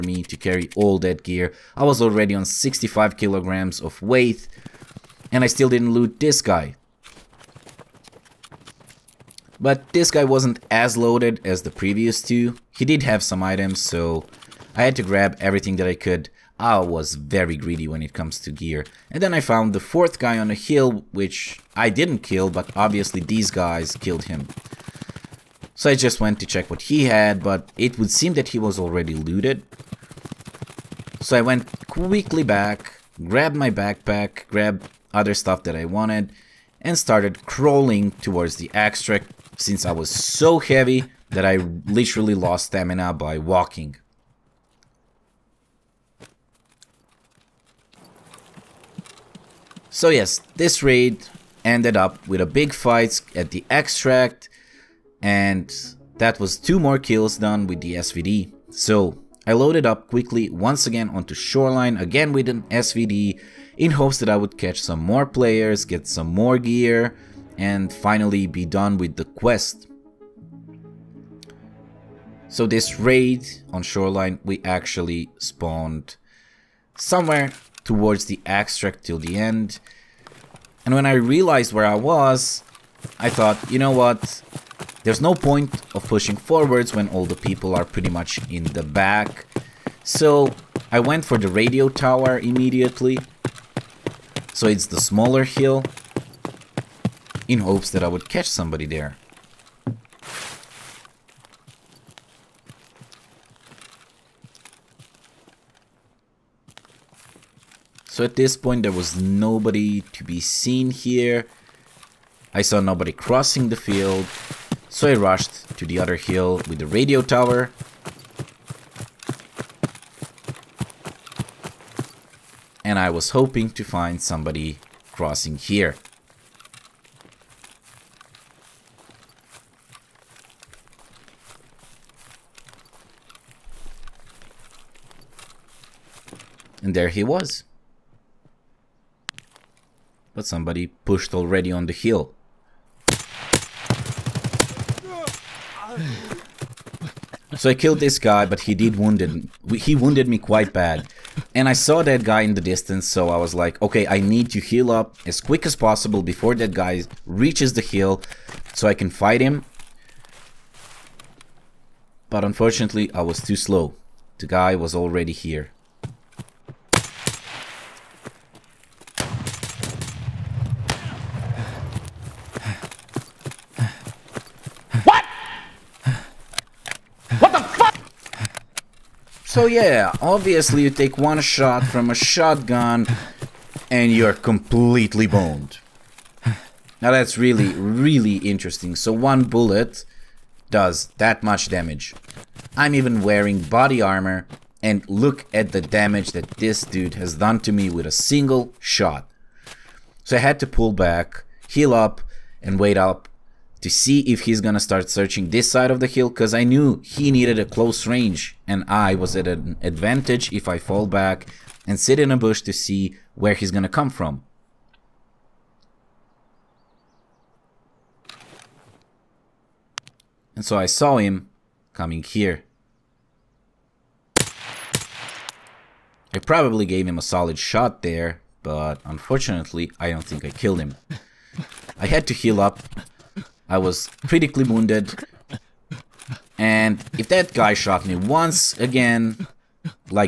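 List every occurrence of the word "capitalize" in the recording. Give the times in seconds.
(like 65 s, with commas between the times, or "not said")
not said.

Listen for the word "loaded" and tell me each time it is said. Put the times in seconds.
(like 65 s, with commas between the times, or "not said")
10 s, 59 s.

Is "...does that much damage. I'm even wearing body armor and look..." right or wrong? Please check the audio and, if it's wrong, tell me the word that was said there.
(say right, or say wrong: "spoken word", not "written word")
right.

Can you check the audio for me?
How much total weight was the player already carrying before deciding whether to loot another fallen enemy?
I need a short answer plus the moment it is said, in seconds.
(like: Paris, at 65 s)
65 kilograms, at 2 s.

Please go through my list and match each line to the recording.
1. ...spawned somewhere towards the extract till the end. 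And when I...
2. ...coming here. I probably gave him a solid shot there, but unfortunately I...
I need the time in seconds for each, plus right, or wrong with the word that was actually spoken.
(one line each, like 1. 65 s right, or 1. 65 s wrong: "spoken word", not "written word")
1. 75 s right
2. 221 s right.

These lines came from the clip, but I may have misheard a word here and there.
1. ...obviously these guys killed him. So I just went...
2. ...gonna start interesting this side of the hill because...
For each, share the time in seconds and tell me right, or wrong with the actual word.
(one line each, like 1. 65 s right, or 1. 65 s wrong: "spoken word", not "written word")
1. 22 s right
2. 204 s wrong: "searching", not "interesting".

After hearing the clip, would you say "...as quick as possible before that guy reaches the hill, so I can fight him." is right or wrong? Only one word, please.
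right.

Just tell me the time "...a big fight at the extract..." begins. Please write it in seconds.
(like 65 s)
52 s.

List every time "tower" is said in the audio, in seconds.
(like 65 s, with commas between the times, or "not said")
91 s, 117 s.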